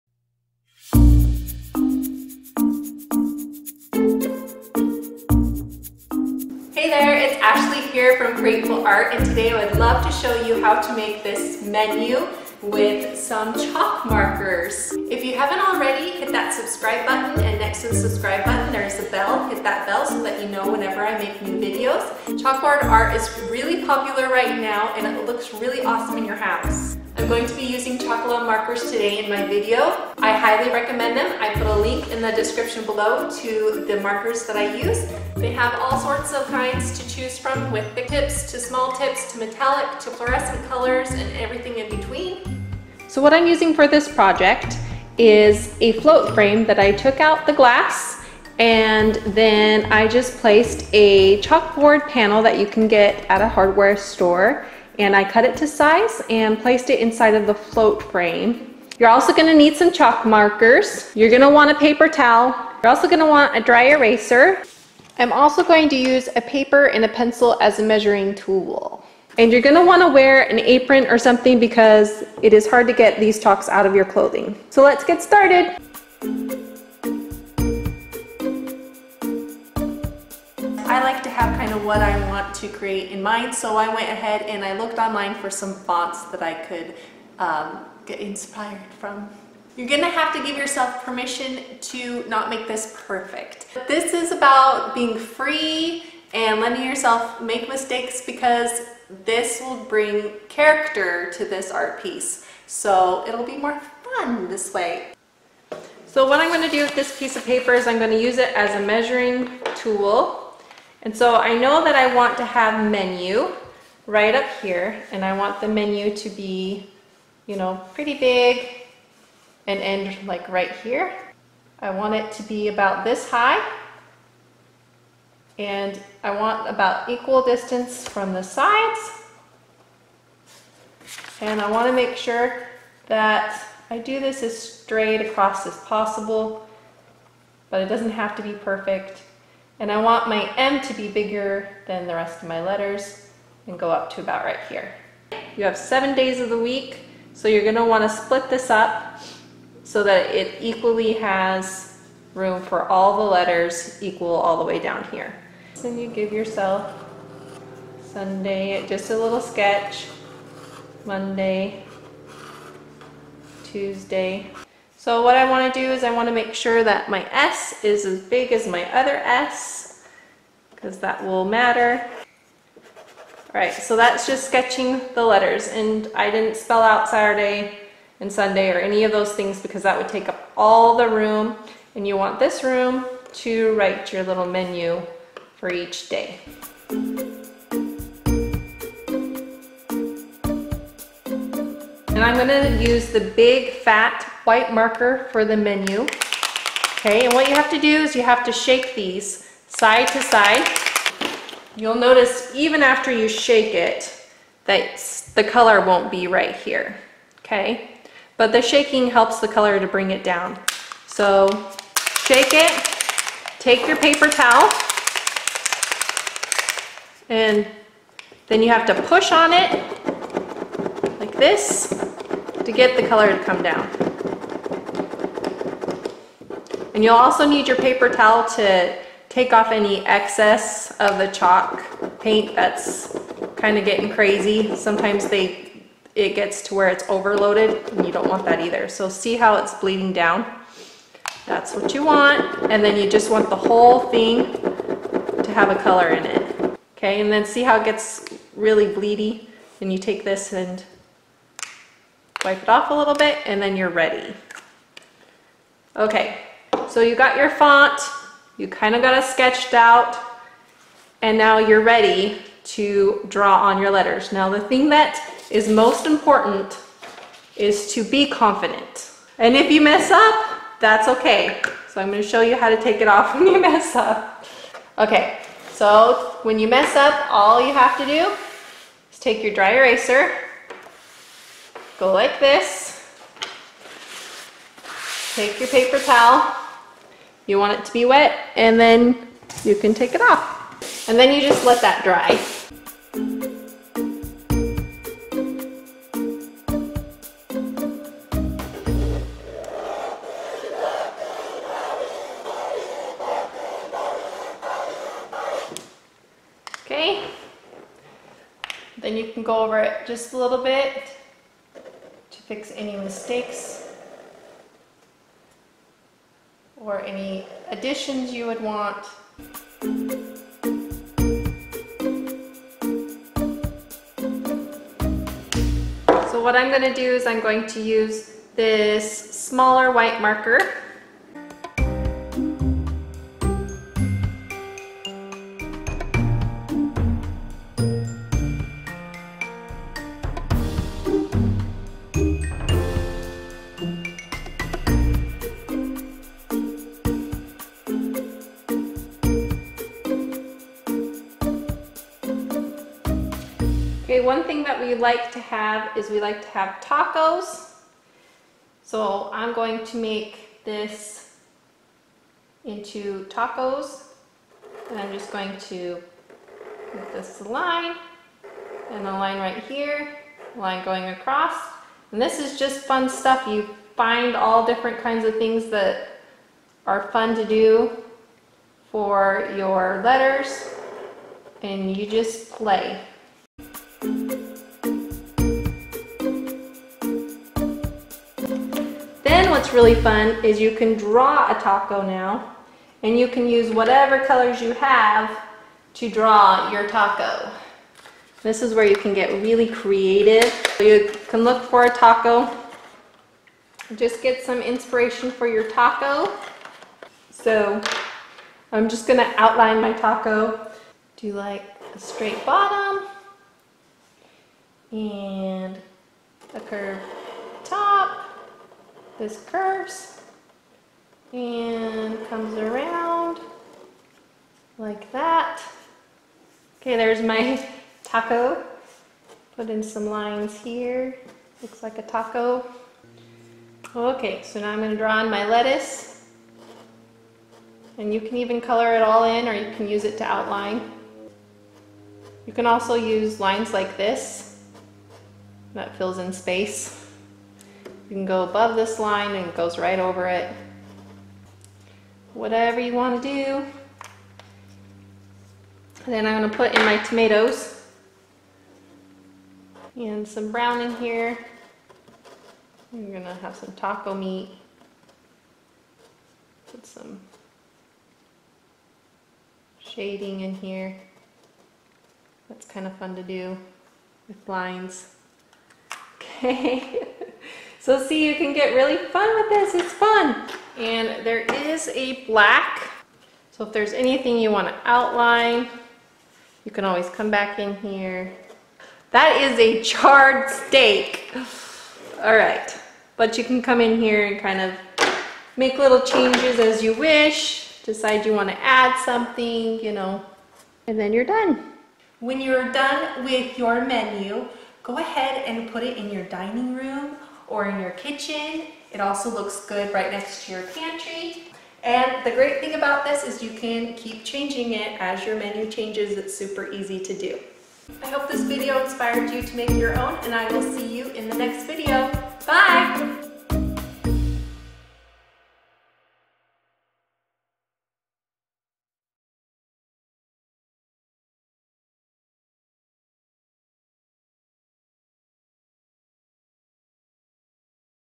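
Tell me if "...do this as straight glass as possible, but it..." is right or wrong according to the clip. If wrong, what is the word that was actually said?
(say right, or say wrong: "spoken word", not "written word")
wrong: "across", not "glass".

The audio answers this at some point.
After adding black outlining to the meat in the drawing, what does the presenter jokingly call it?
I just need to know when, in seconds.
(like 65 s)
489 s.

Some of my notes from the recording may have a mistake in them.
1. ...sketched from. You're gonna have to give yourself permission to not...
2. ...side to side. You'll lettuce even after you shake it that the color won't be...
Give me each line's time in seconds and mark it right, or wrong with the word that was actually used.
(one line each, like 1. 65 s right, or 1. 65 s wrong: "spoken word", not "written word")
1. 88 s wrong: "inspired", not "sketched"
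2. 199 s wrong: "notice", not "lettuce".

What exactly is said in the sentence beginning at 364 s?
And I'm just going to make this line and a line right here, line going across.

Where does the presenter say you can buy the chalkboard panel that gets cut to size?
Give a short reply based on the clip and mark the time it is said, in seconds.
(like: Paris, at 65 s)
hardware store, at 53 s.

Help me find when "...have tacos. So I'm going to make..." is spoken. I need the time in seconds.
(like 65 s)
356 s.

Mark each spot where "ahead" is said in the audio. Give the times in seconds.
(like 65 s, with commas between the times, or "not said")
84 s, 504 s.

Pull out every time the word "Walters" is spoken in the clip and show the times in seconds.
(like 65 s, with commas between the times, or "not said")
not said.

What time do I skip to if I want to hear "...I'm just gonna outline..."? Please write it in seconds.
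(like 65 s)
408 s.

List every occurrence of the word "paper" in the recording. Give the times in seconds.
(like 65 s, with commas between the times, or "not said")
61 s, 66 s, 107 s, 213 s, 227 s, 285 s.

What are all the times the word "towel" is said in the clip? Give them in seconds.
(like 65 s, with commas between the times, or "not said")
62 s, 214 s, 228 s, 285 s.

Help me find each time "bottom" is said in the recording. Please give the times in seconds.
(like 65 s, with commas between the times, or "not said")
412 s.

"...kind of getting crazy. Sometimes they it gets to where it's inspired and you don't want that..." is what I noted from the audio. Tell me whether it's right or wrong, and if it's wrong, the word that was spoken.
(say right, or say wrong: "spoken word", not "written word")
wrong: "overloaded", not "inspired".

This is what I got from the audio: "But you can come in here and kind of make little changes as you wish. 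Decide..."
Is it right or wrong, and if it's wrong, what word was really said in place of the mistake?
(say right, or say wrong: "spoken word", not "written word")
right.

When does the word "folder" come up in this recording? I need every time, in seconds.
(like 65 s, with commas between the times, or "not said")
not said.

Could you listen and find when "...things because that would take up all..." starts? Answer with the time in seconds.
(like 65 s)
179 s.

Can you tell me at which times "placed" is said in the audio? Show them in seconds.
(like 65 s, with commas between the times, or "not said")
50 s, 56 s.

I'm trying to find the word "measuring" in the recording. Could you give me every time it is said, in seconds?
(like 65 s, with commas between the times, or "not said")
67 s, 108 s.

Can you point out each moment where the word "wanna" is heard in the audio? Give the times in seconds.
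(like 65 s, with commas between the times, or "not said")
69 s, 147 s.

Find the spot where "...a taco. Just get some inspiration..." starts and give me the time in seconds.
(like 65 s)
401 s.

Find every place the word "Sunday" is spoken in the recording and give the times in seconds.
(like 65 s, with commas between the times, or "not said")
158 s, 178 s.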